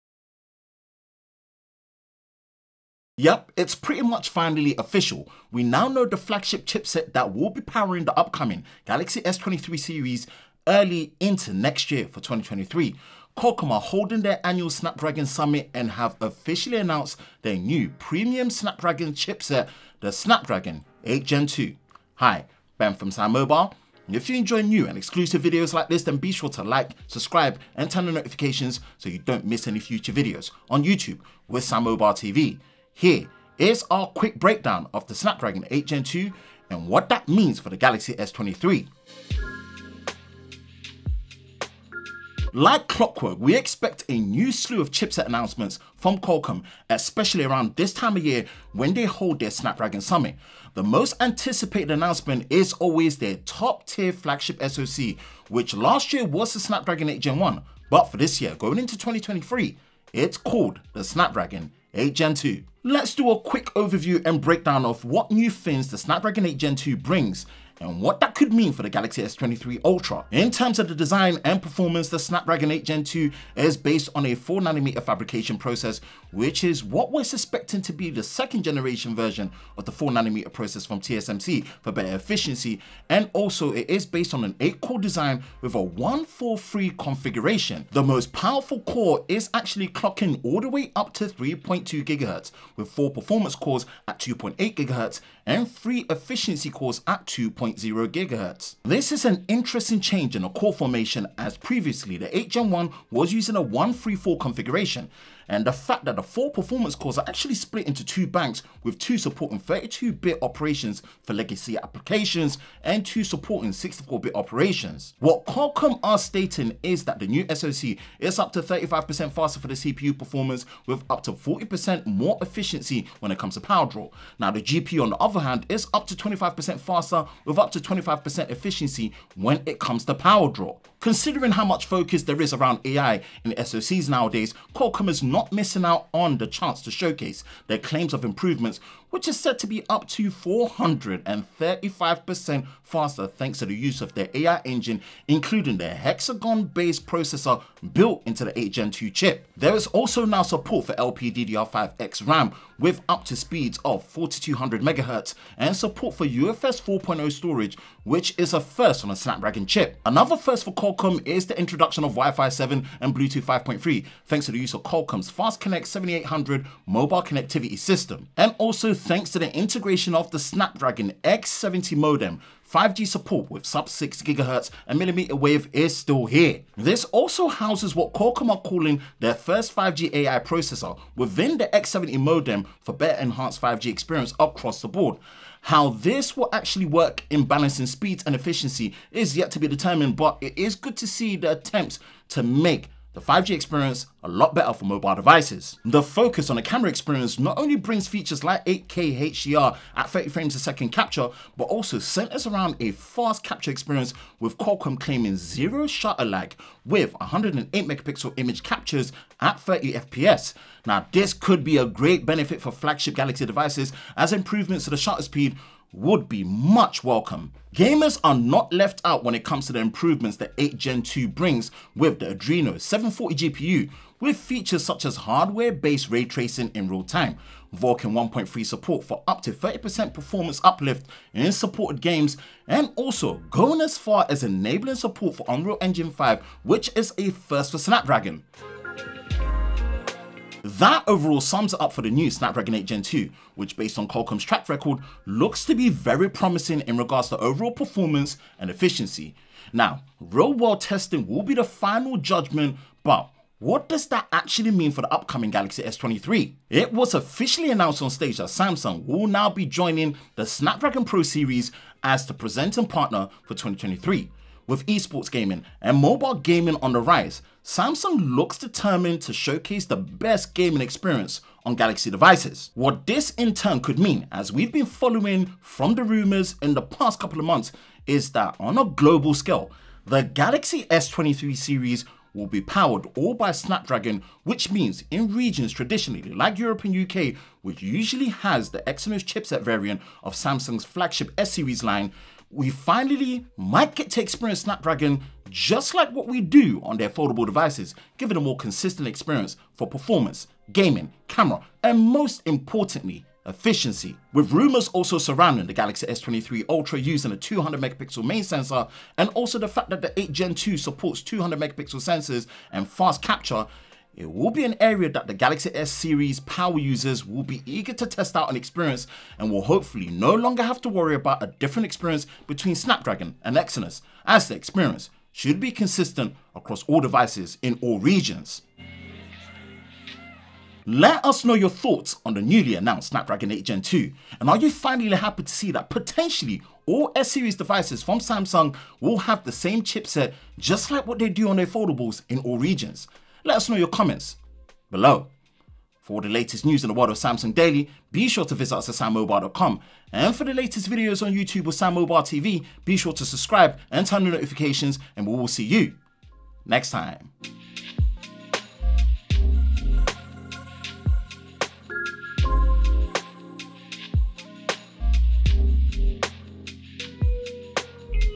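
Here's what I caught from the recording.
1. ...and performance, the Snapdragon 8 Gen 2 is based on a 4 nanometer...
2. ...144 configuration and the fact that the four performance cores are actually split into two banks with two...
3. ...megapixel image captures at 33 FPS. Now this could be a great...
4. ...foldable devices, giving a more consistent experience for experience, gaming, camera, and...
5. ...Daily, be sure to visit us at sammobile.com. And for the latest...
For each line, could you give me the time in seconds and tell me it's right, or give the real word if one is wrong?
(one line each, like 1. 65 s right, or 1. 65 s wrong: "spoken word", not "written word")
1. 71 s right
2. 103 s wrong: "134", not "144"
3. 207 s wrong: "30", not "33"
4. 297 s wrong: "performance", not "experience"
5. 347 s right.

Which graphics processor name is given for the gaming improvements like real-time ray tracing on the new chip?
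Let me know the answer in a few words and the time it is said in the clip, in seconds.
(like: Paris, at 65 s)
Adreno 740, at 222 s.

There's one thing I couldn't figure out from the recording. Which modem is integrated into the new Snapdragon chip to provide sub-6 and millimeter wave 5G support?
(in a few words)
Snapdragon X70.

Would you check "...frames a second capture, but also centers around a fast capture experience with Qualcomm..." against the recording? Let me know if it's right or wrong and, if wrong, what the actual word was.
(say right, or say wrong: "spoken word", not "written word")
right.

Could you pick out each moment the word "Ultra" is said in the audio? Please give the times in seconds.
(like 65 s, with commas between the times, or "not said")
69 s, 306 s.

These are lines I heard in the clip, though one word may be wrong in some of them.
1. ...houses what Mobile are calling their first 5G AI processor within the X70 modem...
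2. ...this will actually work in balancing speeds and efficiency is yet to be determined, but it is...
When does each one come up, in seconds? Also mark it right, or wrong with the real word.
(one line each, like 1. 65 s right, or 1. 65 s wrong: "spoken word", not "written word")
1. 177 s wrong: "Qualcomm", not "Mobile"
2. 185 s right.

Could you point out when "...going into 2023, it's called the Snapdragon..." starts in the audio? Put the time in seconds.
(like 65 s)
58 s.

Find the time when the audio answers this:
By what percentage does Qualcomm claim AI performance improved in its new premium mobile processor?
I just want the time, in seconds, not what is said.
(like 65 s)
140 s.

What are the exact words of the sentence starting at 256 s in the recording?
It was officially announced on stage that Samsung will now be joining the Snapdragon Pro series as the presenting partner for 2023.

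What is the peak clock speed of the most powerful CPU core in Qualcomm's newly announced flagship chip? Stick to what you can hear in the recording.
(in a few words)
3.2 GHz.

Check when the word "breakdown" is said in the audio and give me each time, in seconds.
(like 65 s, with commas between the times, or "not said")
34 s, 64 s.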